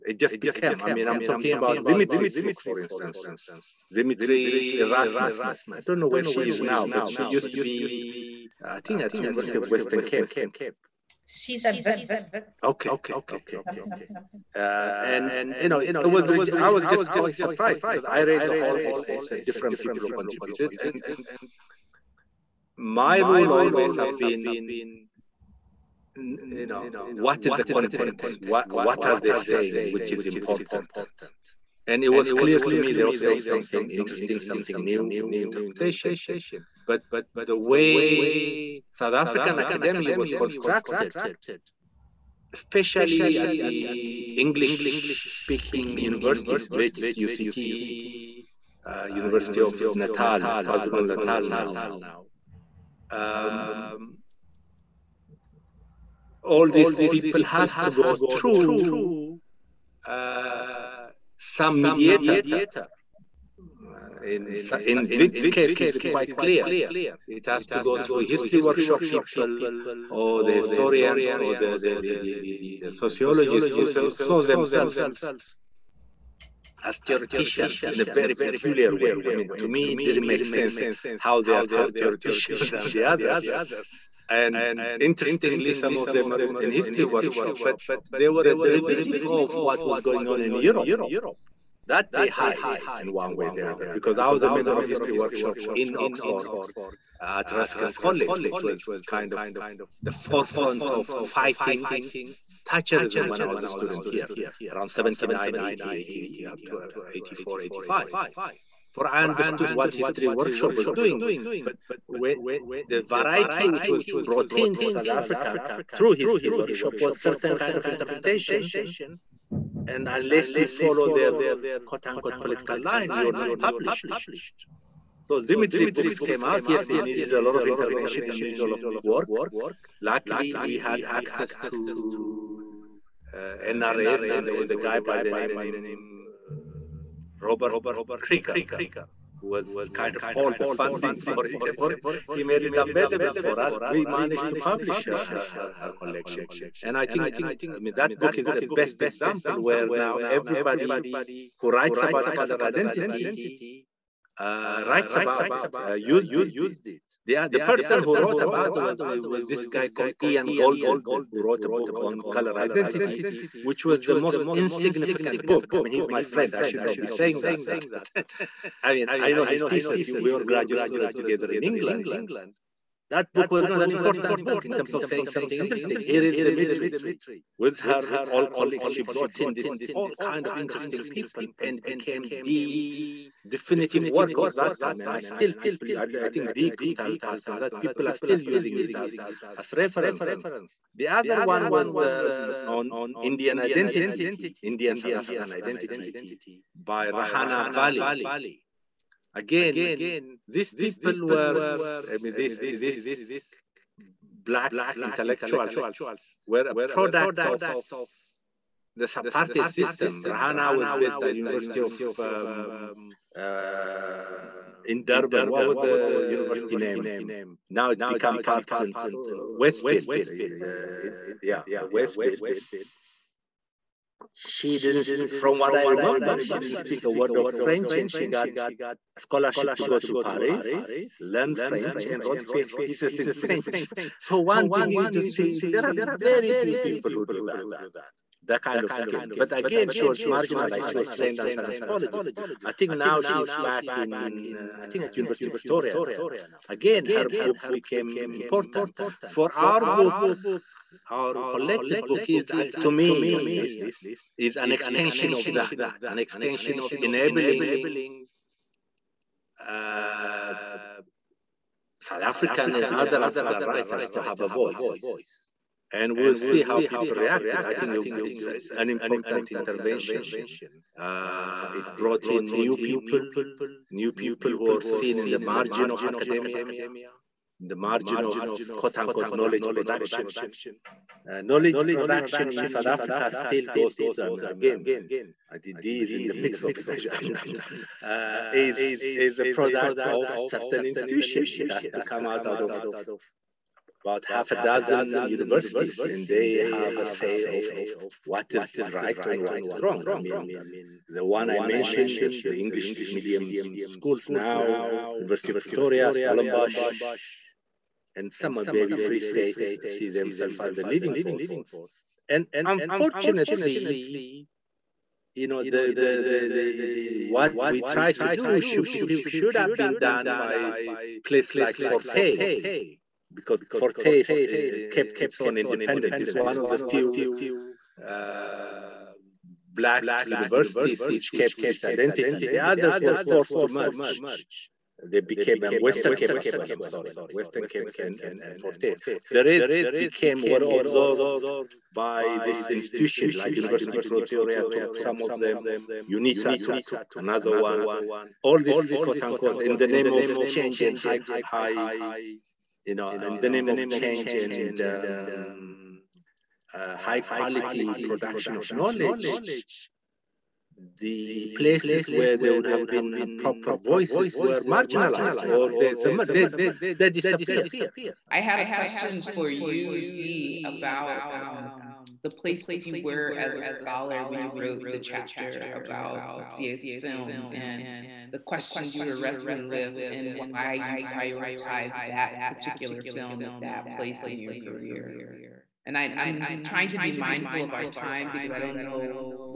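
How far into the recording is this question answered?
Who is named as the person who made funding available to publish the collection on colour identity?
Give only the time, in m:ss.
2:17.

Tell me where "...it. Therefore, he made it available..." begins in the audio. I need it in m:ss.
2:21.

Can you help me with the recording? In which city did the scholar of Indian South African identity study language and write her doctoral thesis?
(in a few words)
Paris.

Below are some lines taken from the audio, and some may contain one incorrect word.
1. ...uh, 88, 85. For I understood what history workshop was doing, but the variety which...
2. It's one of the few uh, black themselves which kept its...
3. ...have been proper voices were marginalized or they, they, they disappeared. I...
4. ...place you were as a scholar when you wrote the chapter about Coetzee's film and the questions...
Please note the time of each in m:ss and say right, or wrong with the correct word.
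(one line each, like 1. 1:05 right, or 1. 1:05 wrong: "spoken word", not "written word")
1. 1:46 wrong: "84", not "88"
2. 5:26 wrong: "universities", not "themselves"
3. 6:02 right
4. 6:12 right.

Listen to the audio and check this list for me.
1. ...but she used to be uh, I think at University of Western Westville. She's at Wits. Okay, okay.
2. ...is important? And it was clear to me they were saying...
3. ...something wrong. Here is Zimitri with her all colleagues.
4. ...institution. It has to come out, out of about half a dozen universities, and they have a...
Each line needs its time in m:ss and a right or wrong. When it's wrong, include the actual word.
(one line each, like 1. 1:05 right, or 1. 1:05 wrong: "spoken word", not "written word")
1. 0:06 wrong: "Cape", not "Westville"
2. 0:30 right
3. 2:55 wrong: "interesting", not "wrong"
4. 4:50 right.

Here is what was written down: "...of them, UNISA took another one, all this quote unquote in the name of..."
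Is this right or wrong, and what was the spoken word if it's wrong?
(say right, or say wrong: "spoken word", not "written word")
right.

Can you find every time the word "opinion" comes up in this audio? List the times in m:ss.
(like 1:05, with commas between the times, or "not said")
not said.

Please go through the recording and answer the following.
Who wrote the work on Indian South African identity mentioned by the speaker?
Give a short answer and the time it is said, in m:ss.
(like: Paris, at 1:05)
Rehana Vally, at 3:17.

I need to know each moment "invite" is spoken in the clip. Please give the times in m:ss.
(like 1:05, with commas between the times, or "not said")
not said.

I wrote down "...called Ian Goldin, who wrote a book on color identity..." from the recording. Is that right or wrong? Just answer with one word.
right.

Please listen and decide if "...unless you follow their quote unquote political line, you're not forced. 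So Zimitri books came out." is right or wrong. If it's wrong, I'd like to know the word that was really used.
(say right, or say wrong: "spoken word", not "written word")
wrong: "published", not "forced".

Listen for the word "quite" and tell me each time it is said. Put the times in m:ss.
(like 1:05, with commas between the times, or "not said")
0:17, 1:06.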